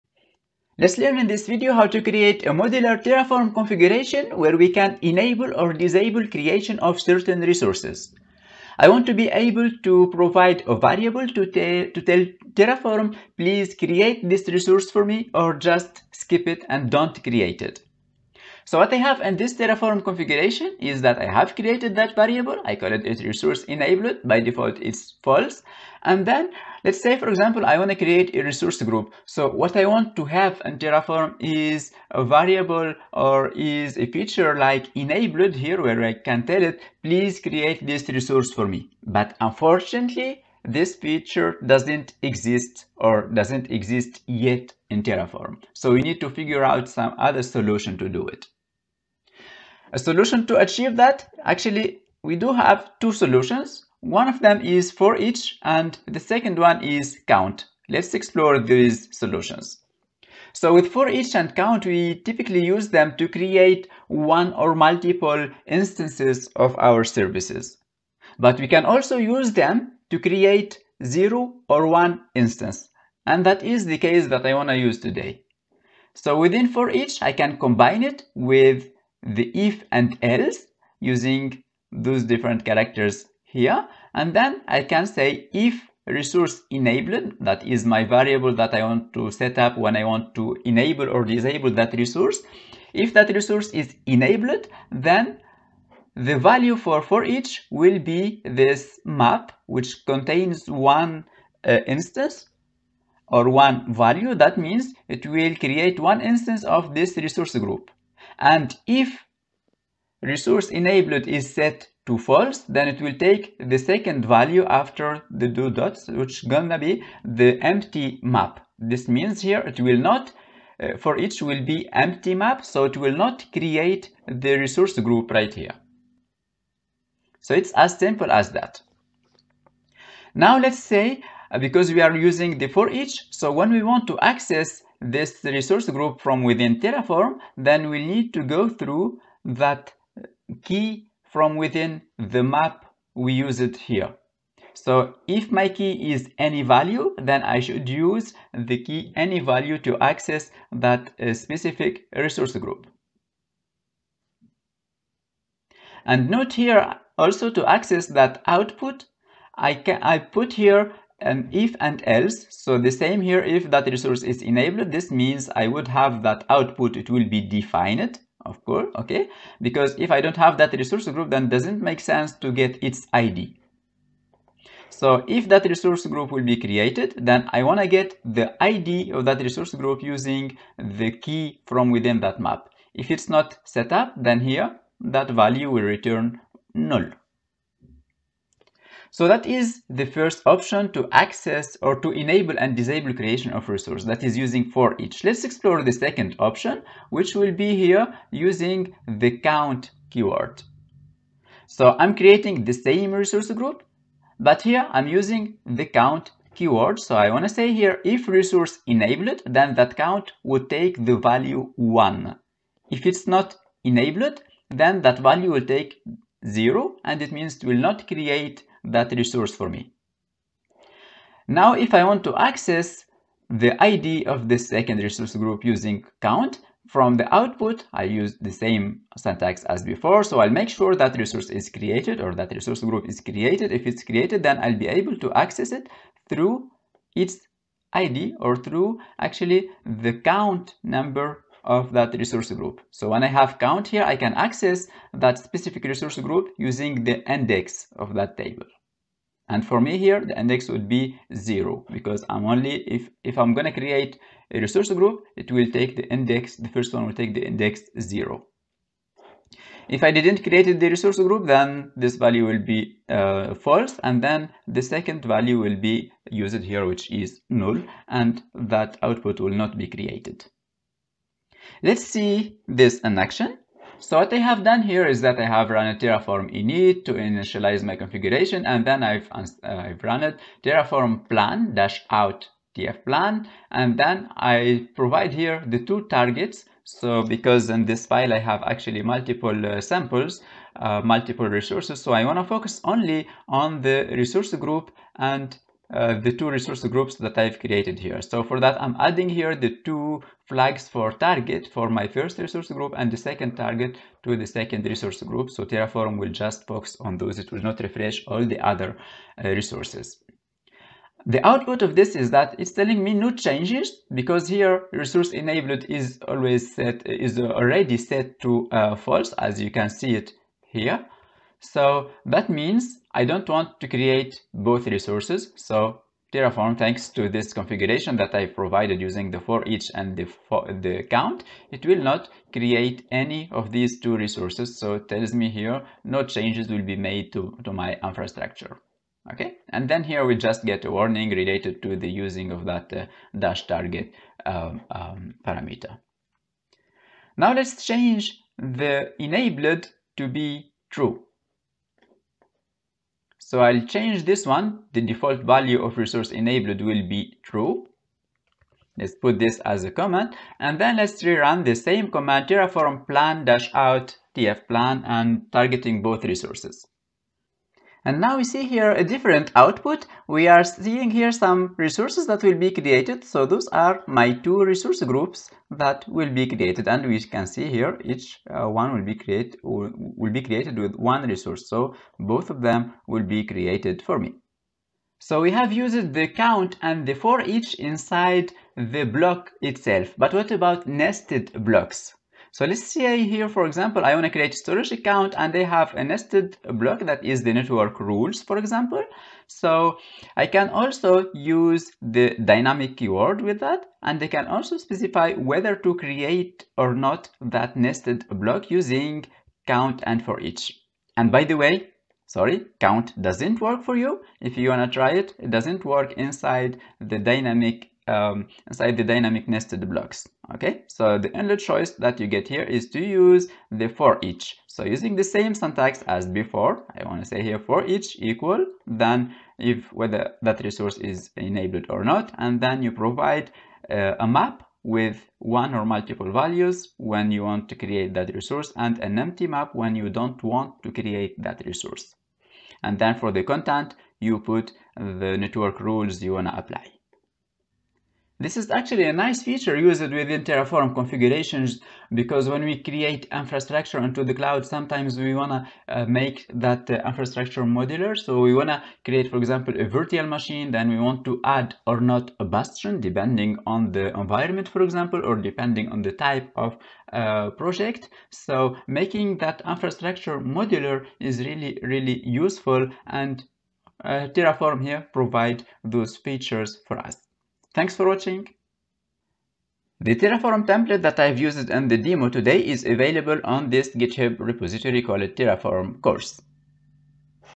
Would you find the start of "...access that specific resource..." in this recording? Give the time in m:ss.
4:04.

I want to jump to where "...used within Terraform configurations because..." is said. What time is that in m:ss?
7:29.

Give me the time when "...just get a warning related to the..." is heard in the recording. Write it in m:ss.
5:40.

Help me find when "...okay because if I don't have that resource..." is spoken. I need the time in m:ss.
2:48.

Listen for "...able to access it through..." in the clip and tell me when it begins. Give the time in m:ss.
3:54.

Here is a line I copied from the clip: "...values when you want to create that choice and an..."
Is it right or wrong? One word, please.
wrong.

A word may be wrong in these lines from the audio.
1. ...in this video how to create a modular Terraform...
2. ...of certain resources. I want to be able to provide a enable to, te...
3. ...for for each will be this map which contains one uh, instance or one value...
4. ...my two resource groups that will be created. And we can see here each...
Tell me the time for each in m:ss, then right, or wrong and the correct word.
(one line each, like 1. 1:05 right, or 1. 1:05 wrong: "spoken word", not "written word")
1. 0:01 right
2. 0:06 wrong: "variable", not "enable"
3. 1:36 right
4. 6:14 right.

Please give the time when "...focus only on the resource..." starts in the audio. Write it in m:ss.
4:52.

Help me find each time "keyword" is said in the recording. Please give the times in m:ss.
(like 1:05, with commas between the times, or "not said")
3:20, 3:26, 6:42.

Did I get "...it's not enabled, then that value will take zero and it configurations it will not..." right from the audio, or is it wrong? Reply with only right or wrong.
wrong.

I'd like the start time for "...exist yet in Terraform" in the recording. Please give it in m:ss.
0:43.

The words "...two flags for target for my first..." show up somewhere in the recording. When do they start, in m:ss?
4:59.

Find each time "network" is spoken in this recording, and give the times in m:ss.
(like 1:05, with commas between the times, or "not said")
6:37, 7:25.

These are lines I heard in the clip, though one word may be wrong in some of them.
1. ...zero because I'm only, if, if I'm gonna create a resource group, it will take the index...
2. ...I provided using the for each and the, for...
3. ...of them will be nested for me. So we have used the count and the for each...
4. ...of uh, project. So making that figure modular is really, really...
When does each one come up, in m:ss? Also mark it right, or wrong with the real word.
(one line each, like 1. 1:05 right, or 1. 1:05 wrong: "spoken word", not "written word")
1. 4:11 right
2. 5:28 right
3. 6:22 wrong: "created", not "nested"
4. 7:46 wrong: "infrastructure", not "figure".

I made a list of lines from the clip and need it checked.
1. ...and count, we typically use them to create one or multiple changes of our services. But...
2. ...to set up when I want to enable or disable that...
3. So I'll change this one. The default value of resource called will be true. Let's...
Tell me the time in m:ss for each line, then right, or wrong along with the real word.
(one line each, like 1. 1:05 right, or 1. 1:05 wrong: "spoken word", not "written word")
1. 1:01 wrong: "instances", not "changes"
2. 1:29 right
3. 5:53 wrong: "enabled", not "called".